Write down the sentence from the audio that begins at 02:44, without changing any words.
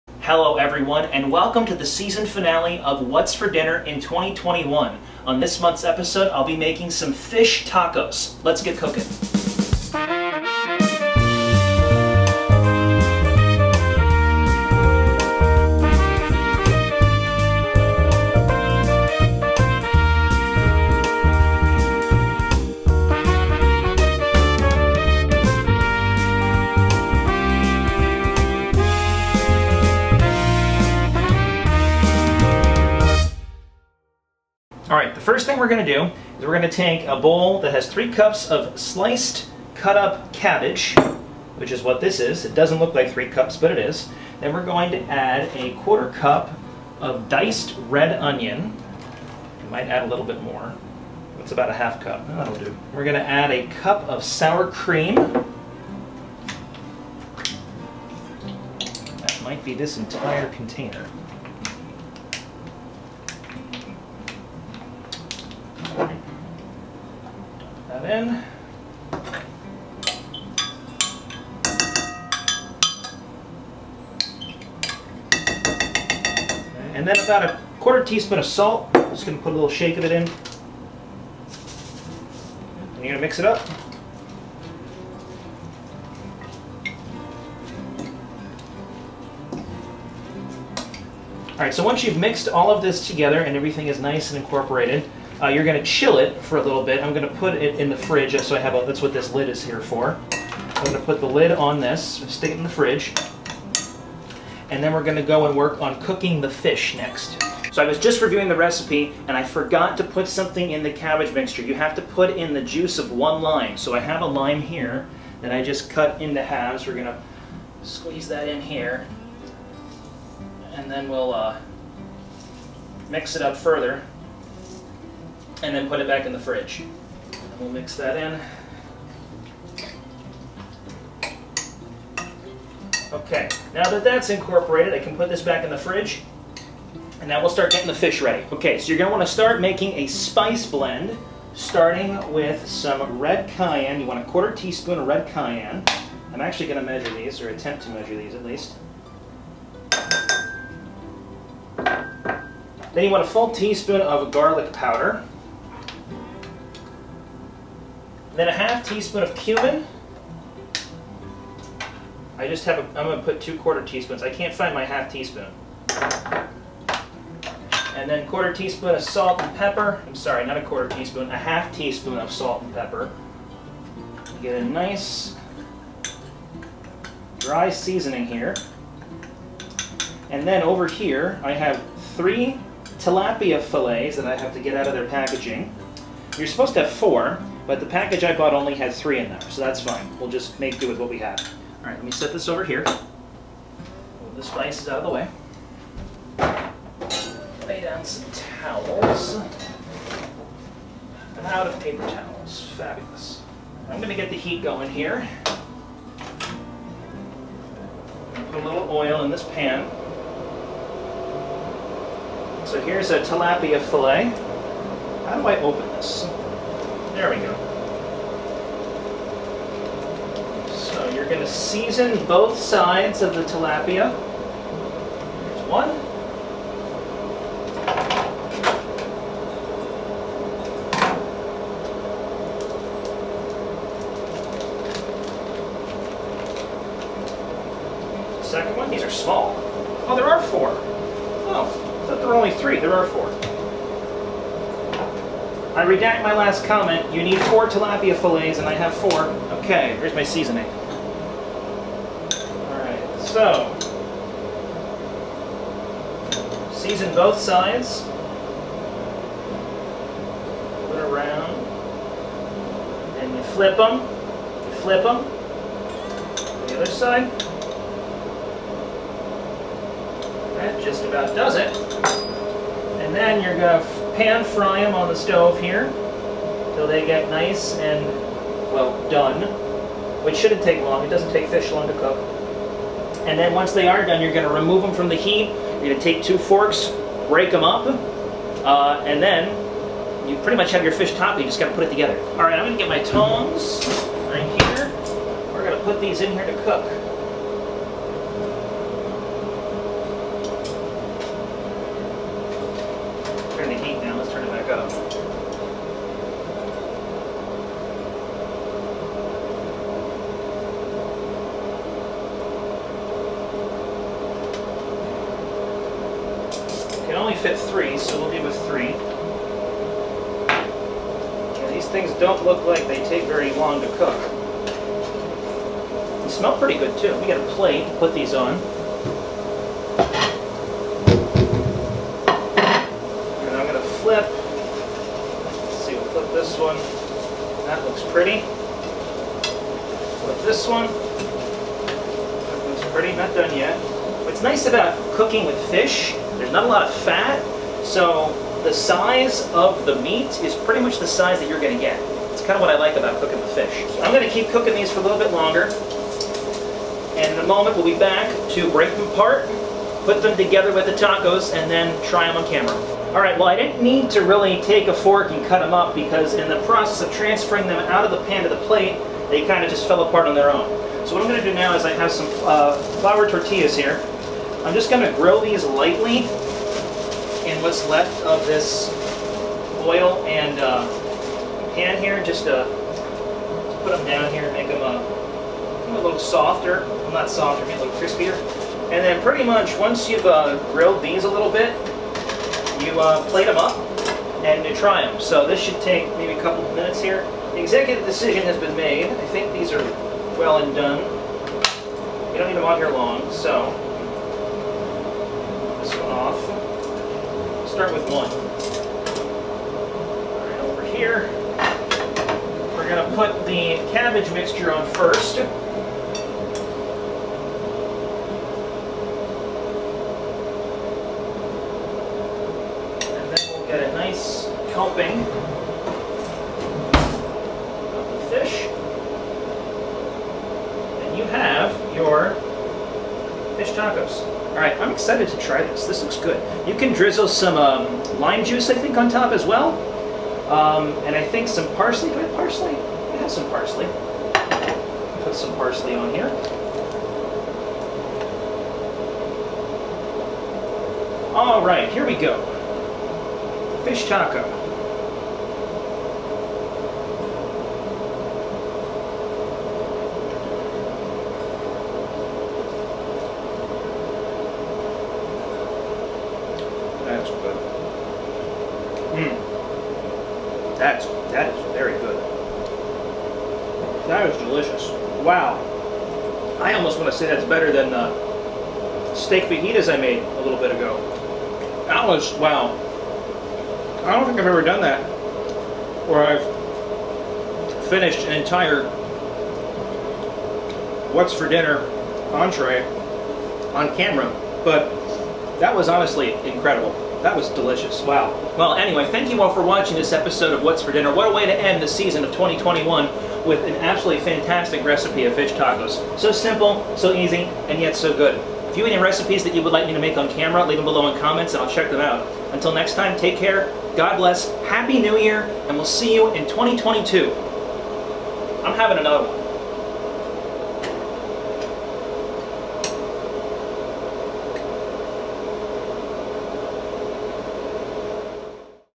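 I can't find my half teaspoon.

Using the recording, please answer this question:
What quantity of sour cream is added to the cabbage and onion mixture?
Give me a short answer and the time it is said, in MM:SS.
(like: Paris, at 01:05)
1 cup, at 00:53.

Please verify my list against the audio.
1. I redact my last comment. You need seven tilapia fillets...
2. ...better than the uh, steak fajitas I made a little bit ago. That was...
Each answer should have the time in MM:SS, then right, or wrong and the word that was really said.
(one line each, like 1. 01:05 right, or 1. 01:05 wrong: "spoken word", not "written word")
1. 04:05 wrong: "four", not "seven"
2. 07:57 right.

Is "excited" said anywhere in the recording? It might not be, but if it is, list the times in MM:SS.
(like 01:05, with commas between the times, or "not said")
07:14.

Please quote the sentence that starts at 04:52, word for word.
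All right, I'm going to get my tongs right here.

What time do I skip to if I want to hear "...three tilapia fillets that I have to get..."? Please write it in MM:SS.
03:02.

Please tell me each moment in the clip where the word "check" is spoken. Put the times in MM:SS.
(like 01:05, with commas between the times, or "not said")
08:31.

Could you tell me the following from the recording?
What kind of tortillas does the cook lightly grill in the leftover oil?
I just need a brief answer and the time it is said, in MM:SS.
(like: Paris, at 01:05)
flour tortillas, at 06:12.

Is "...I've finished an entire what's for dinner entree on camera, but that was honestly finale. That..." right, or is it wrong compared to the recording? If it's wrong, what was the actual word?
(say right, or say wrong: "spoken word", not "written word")
wrong: "incredible", not "finale".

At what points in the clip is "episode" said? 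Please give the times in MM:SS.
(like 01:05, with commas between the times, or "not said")
00:05, 08:20.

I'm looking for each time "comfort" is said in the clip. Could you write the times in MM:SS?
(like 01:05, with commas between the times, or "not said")
not said.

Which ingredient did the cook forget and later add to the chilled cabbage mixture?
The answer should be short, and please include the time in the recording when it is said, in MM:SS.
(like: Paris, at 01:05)
juice of one lime, at 01:52.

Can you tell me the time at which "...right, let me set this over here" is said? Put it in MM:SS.
03:11.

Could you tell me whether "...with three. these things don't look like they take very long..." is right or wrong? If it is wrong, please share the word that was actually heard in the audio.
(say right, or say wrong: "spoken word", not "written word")
right.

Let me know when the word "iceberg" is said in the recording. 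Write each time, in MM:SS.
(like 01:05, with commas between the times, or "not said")
not said.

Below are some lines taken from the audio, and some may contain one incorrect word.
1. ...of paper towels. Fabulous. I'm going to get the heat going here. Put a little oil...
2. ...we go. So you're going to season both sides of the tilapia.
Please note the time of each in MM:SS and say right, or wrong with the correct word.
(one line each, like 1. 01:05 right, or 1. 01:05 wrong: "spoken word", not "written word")
1. 03:21 right
2. 03:37 right.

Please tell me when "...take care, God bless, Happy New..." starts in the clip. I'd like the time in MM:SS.
08:33.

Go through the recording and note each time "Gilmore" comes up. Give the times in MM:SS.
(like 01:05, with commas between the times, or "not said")
not said.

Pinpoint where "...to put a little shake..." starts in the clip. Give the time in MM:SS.
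01:19.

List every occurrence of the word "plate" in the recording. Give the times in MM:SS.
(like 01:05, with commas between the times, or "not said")
05:27, 06:08, 06:33.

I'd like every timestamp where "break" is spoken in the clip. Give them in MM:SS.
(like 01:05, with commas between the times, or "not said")
04:47, 05:58.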